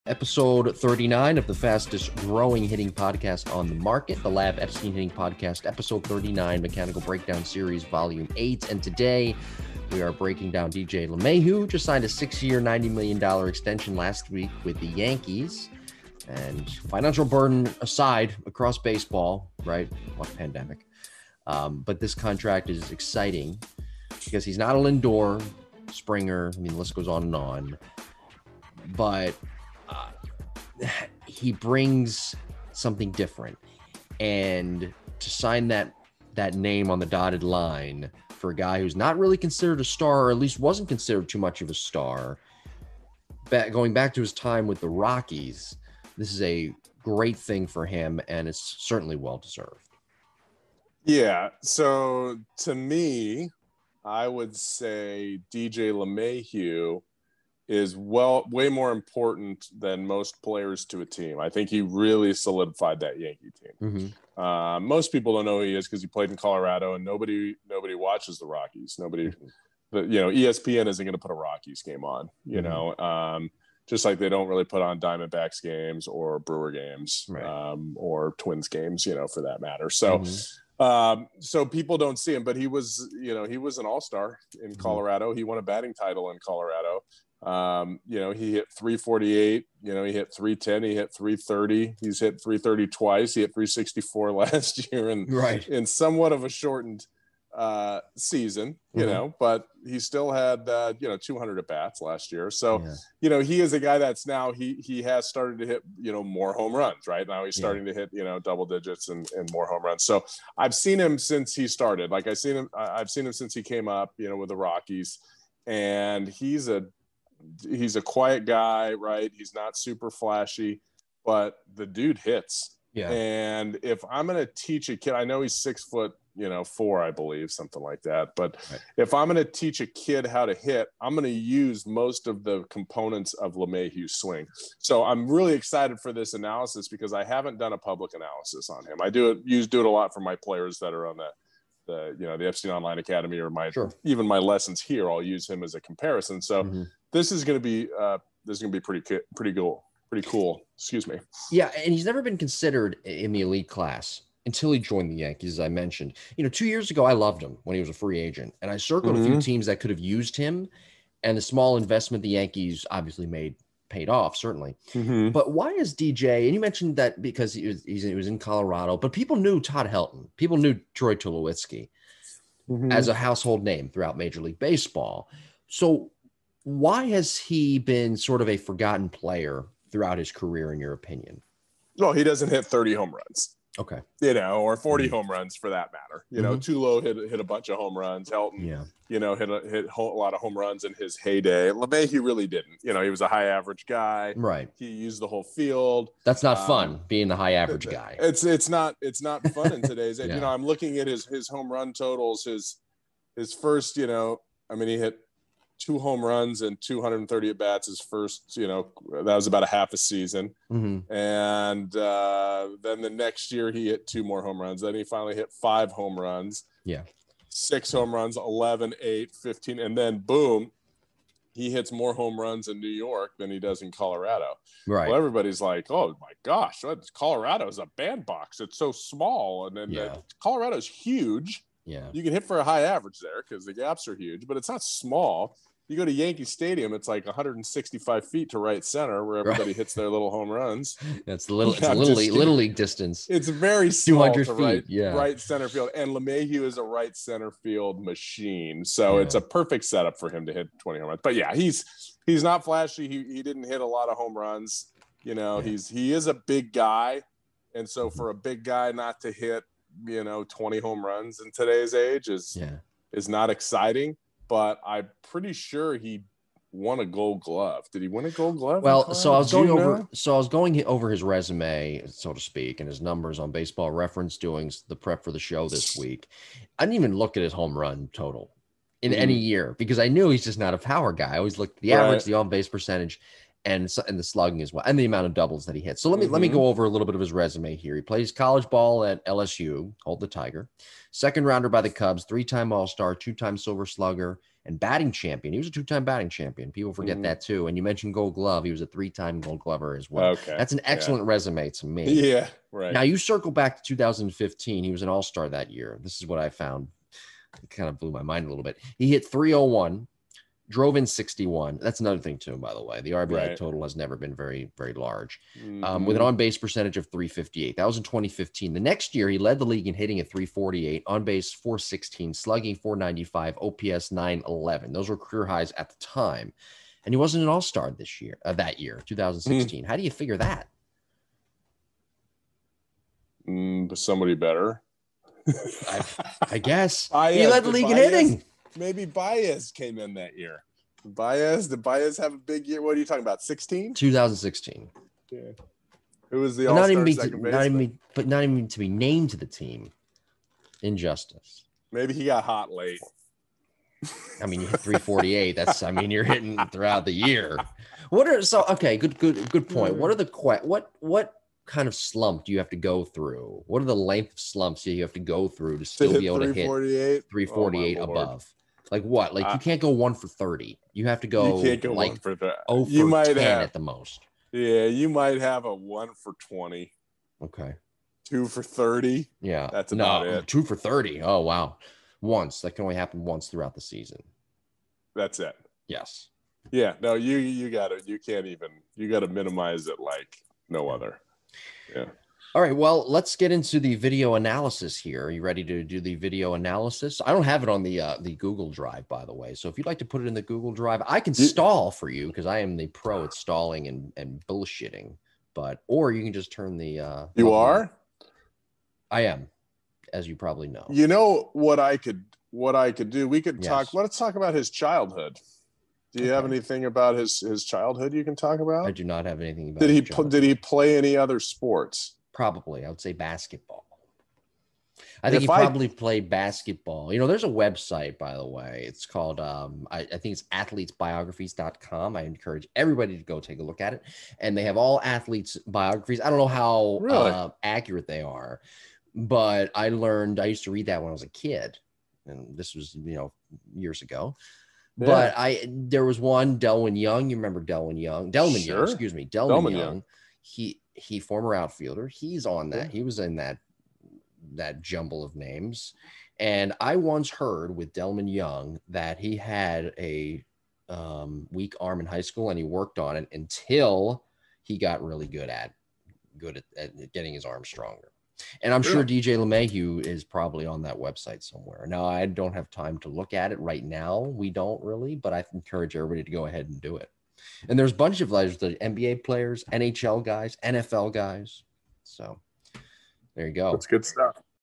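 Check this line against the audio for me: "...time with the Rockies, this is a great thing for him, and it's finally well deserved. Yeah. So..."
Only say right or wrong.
wrong.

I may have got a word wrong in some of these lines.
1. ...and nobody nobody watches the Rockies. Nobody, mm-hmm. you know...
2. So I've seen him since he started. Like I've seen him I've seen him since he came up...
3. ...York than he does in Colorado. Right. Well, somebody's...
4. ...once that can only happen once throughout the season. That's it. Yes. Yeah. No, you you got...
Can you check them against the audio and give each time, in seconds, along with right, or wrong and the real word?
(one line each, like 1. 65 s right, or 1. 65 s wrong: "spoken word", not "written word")
1. 66 s right
2. 110 s right
3. 222 s wrong: "everybody", not "somebody"
4. 382 s right.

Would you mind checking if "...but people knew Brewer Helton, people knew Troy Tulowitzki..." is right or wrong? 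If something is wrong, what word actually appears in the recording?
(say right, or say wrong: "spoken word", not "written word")
wrong: "Todd", not "Brewer".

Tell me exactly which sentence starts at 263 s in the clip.
is not exciting but I'm pretty sure he won a Gold Glove.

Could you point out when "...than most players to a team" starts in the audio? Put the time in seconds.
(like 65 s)
59 s.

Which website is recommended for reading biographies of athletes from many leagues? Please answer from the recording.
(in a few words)
athletesbiographies.com.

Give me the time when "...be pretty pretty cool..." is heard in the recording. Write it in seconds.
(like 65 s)
148 s.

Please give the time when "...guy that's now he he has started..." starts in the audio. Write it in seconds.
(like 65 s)
103 s.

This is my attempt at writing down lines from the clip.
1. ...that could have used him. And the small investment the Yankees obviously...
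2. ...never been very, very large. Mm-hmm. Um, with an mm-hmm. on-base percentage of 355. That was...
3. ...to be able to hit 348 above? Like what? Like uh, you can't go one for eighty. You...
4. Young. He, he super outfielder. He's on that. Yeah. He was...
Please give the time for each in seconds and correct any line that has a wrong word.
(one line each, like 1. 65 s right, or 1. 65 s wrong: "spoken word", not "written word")
1. 159 s right
2. 313 s wrong: "358", not "355"
3. 366 s wrong: "thirty", not "eighty"
4. 449 s wrong: "former", not "super".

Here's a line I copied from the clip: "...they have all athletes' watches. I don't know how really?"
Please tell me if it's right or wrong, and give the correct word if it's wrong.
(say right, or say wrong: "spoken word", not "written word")
wrong: "biographies", not "watches".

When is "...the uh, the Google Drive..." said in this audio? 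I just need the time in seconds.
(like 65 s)
397 s.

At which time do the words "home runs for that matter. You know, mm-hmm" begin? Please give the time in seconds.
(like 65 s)
185 s.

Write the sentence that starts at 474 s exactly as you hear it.
We don't really, but I encourage everybody to go ahead and do it.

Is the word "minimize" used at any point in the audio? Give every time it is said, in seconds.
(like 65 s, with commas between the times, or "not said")
389 s.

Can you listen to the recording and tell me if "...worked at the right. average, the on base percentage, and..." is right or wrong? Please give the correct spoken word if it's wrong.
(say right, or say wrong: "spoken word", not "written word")
wrong: "looked", not "worked".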